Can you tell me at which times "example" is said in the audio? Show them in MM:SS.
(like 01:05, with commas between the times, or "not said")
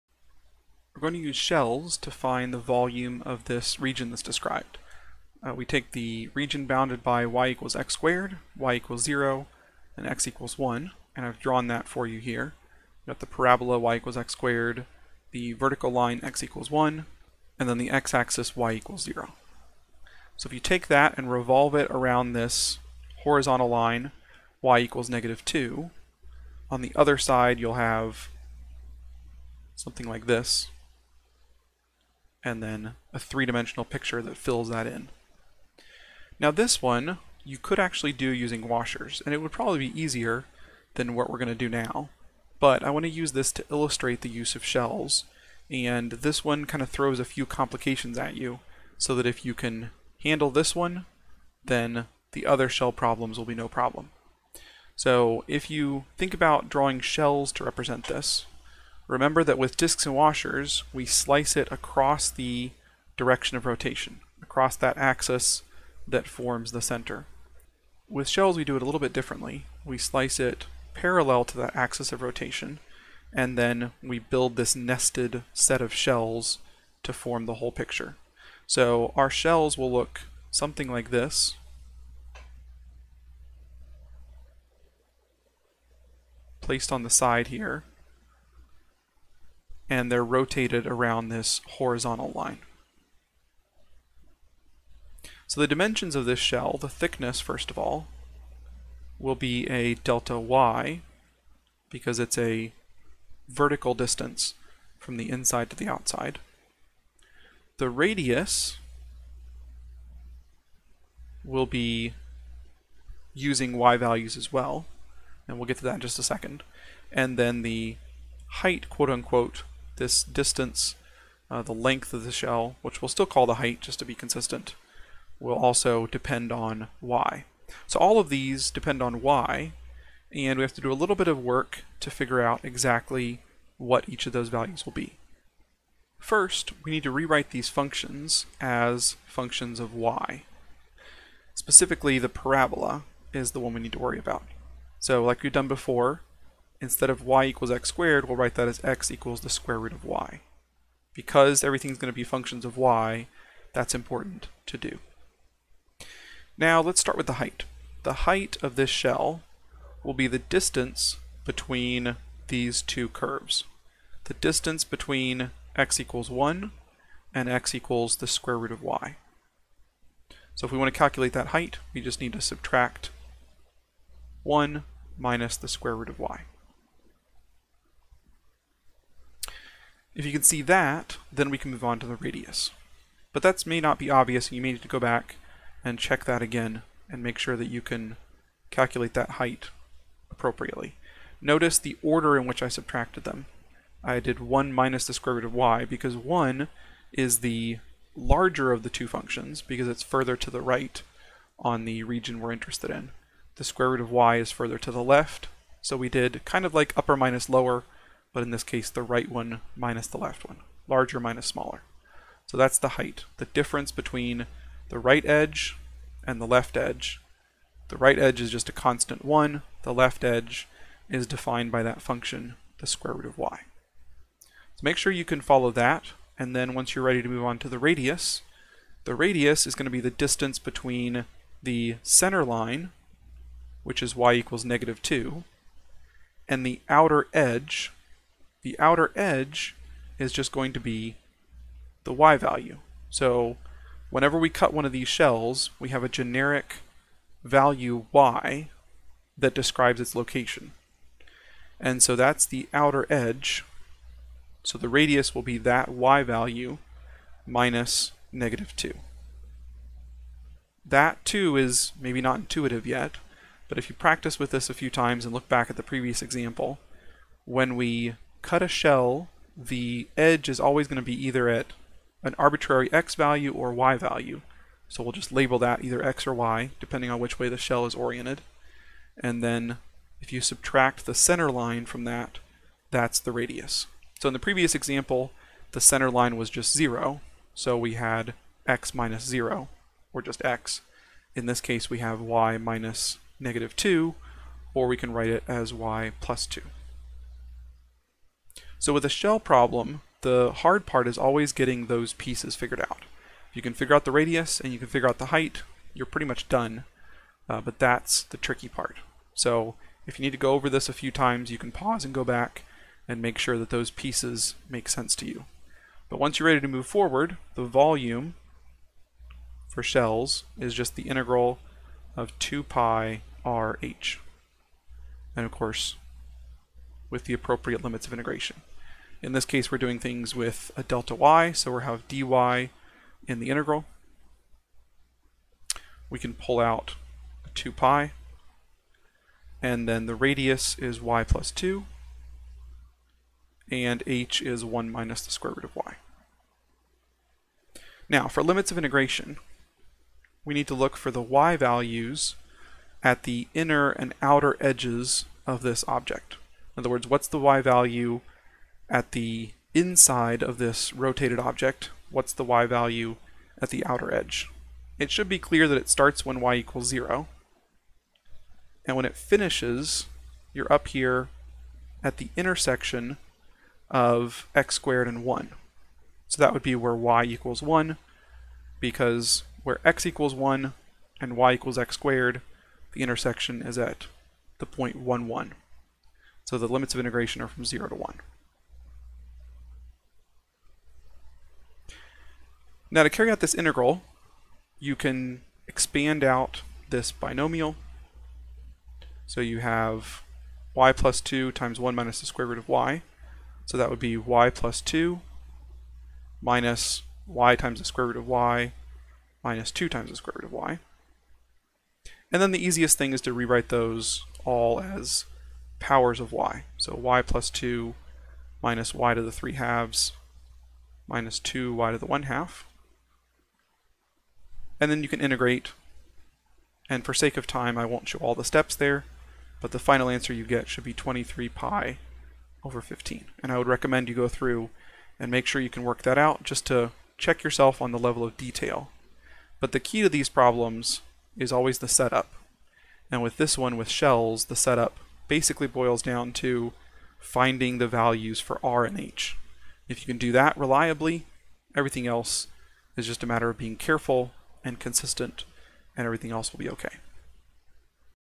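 04:26, 04:44.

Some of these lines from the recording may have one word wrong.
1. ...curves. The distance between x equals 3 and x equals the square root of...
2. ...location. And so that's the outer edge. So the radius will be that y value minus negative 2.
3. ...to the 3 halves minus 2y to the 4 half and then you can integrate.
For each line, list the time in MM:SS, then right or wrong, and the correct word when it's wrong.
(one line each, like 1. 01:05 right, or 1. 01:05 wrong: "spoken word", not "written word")
1. 02:43 wrong: "1", not "3"
2. 04:10 right
3. 06:59 wrong: "1", not "4".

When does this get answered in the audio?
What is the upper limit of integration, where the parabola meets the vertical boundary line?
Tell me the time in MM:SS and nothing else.
06:16.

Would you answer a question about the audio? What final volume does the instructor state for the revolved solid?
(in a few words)
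23π/15.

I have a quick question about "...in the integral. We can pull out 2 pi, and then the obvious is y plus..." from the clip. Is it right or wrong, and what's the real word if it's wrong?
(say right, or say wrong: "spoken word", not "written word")
wrong: "radius", not "obvious".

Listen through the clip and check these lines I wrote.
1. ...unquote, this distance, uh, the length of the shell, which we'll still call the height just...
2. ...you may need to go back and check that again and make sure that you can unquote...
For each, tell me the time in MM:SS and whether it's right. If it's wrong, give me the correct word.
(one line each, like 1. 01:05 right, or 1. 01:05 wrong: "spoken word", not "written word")
1. 01:59 right
2. 03:04 wrong: "calculate", not "unquote".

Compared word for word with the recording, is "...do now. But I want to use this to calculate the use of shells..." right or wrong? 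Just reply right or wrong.
wrong.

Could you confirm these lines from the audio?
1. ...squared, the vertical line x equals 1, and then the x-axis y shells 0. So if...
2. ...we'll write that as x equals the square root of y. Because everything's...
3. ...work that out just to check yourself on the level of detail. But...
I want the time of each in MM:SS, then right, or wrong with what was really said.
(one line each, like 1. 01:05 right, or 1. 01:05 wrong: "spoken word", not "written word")
1. 00:14 wrong: "equals", not "shells"
2. 02:28 right
3. 07:15 right.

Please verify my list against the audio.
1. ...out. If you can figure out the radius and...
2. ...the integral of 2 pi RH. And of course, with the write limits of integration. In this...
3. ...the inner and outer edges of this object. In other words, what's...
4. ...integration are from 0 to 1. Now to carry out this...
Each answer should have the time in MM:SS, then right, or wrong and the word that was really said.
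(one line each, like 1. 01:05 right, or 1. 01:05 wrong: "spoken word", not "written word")
1. 05:02 right
2. 05:20 wrong: "appropriate", not "write"
3. 05:53 right
4. 06:26 right.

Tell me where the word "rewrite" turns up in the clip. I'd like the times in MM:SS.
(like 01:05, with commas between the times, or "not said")
02:17, 06:53.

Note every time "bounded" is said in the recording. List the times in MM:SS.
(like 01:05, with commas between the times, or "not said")
00:06.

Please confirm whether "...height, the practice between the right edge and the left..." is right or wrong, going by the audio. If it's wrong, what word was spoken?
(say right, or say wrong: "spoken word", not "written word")
wrong: "difference", not "practice".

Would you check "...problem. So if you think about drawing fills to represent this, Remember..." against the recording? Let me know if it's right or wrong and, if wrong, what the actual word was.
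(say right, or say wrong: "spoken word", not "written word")
wrong: "shells", not "fills".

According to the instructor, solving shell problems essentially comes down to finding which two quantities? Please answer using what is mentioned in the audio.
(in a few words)
R and H.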